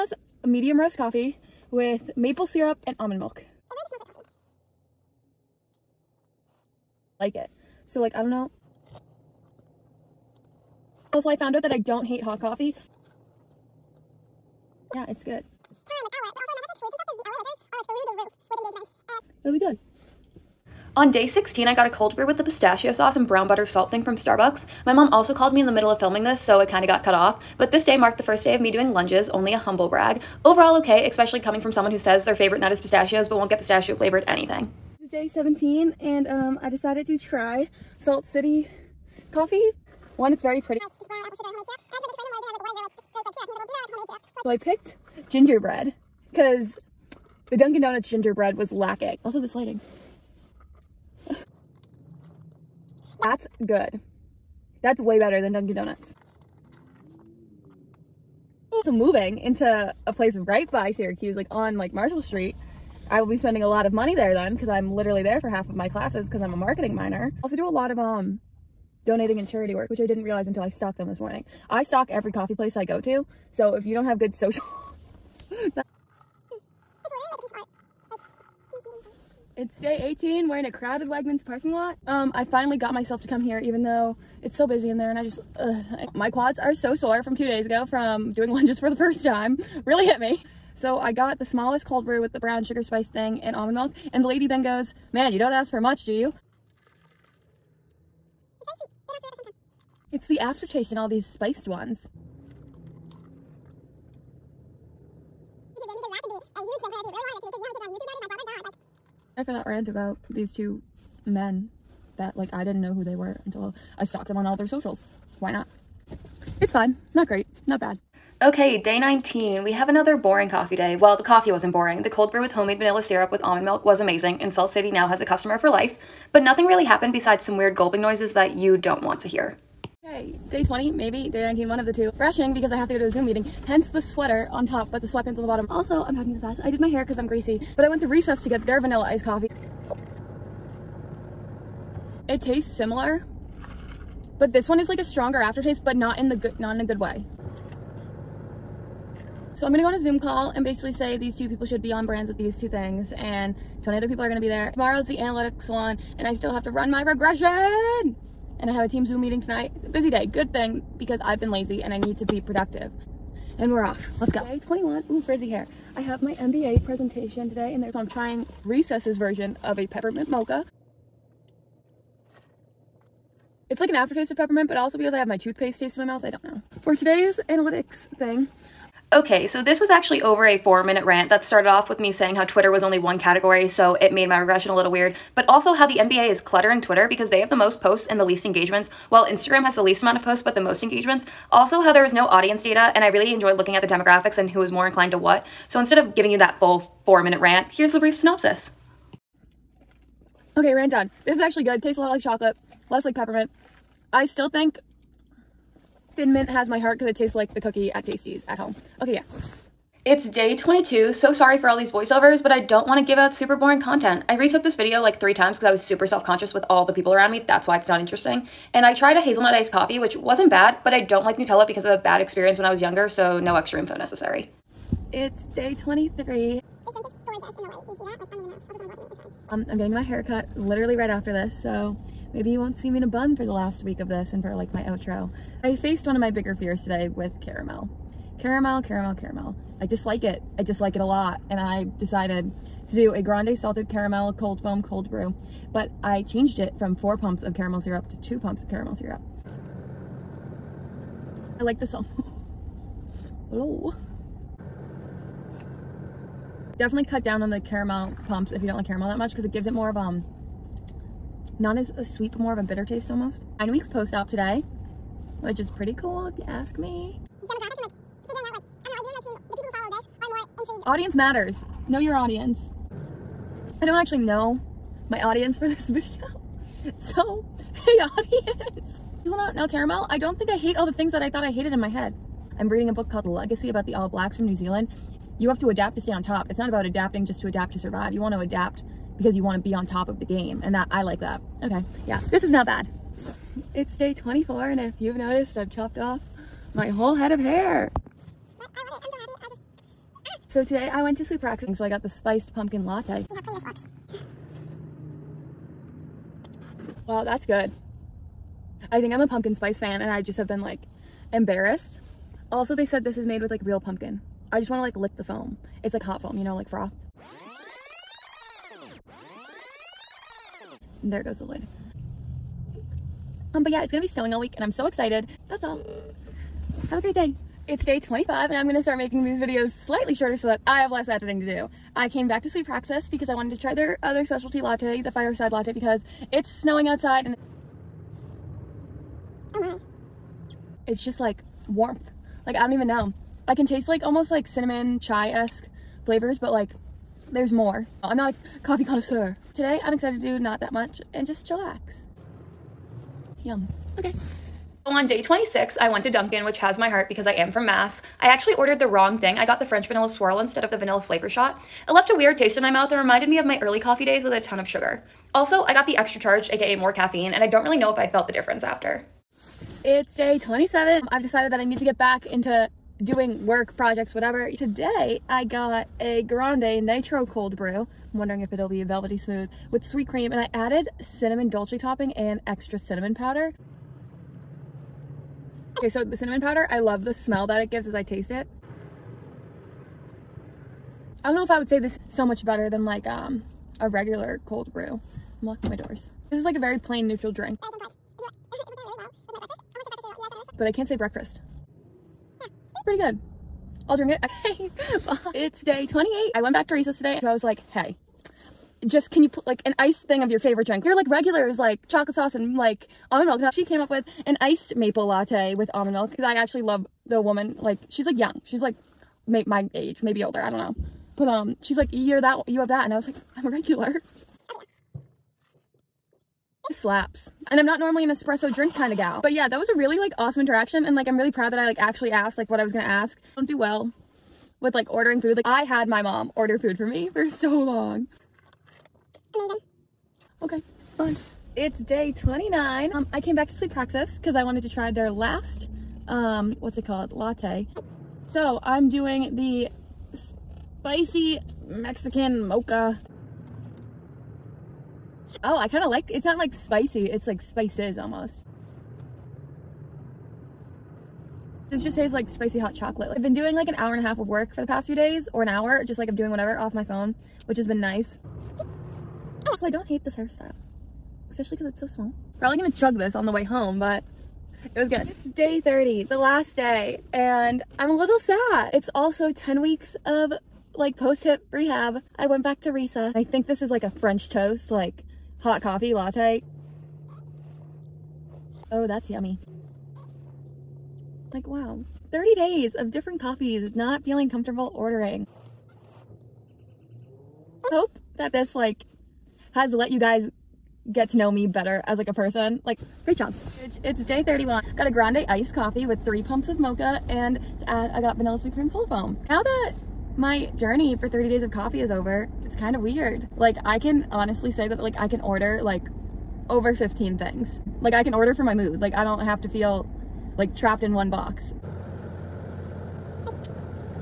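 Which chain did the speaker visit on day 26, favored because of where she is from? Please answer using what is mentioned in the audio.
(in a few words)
Dunkin'.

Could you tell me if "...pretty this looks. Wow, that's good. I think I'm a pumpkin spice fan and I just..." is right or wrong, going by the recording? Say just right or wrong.
right.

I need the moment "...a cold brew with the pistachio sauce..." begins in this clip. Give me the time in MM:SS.
00:21.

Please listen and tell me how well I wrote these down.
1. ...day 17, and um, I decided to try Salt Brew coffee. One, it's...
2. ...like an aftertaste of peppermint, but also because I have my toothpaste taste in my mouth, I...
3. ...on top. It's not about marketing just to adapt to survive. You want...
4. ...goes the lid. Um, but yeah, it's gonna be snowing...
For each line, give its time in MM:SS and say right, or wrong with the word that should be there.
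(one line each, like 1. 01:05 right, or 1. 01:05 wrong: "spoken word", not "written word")
1. 00:35 wrong: "City", not "Brew"
2. 02:53 right
3. 04:46 wrong: "adapting", not "marketing"
4. 05:21 right.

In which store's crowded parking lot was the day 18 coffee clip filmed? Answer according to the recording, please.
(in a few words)
Wegmans.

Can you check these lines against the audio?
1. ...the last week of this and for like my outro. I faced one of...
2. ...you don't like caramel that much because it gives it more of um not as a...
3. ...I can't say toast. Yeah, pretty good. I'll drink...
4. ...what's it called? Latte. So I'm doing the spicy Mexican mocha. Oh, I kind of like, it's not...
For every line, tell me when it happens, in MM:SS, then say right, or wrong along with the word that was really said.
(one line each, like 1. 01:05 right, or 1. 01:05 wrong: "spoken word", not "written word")
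1. 03:53 right
2. 04:18 right
3. 06:40 wrong: "breakfast", not "toast"
4. 07:26 right.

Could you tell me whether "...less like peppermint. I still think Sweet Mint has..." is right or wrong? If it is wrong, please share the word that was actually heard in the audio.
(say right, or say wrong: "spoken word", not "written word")
wrong: "Thin", not "Sweet".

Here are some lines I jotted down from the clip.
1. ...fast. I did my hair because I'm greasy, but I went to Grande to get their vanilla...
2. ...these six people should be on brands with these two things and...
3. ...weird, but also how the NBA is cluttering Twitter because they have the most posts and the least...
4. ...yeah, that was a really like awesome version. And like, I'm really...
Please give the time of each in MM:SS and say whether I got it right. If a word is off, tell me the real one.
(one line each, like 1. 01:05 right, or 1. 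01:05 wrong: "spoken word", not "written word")
1. 02:16 wrong: "Recess", not "Grande"
2. 02:31 wrong: "two", not "six"
3. 03:04 right
4. 07:09 wrong: "interaction", not "version".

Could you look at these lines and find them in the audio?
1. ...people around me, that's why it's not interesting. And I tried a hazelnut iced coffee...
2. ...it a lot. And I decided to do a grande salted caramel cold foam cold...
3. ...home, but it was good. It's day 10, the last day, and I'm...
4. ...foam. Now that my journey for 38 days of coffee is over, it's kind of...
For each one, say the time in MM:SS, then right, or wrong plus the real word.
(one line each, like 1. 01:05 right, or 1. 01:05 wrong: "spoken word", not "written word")
1. 03:36 right
2. 04:00 right
3. 07:53 wrong: "30", not "10"
4. 08:28 wrong: "30", not "38".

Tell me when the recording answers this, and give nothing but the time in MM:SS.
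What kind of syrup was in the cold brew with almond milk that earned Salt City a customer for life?
02:02.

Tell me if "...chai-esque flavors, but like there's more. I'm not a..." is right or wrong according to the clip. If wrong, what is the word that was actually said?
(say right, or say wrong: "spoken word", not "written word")
right.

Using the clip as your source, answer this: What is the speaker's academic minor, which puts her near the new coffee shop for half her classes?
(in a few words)
Marketing.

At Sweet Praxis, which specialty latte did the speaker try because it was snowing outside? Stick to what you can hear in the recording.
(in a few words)
Fireside latte.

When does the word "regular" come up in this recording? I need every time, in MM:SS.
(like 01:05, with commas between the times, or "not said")
06:33, 06:51, 07:03.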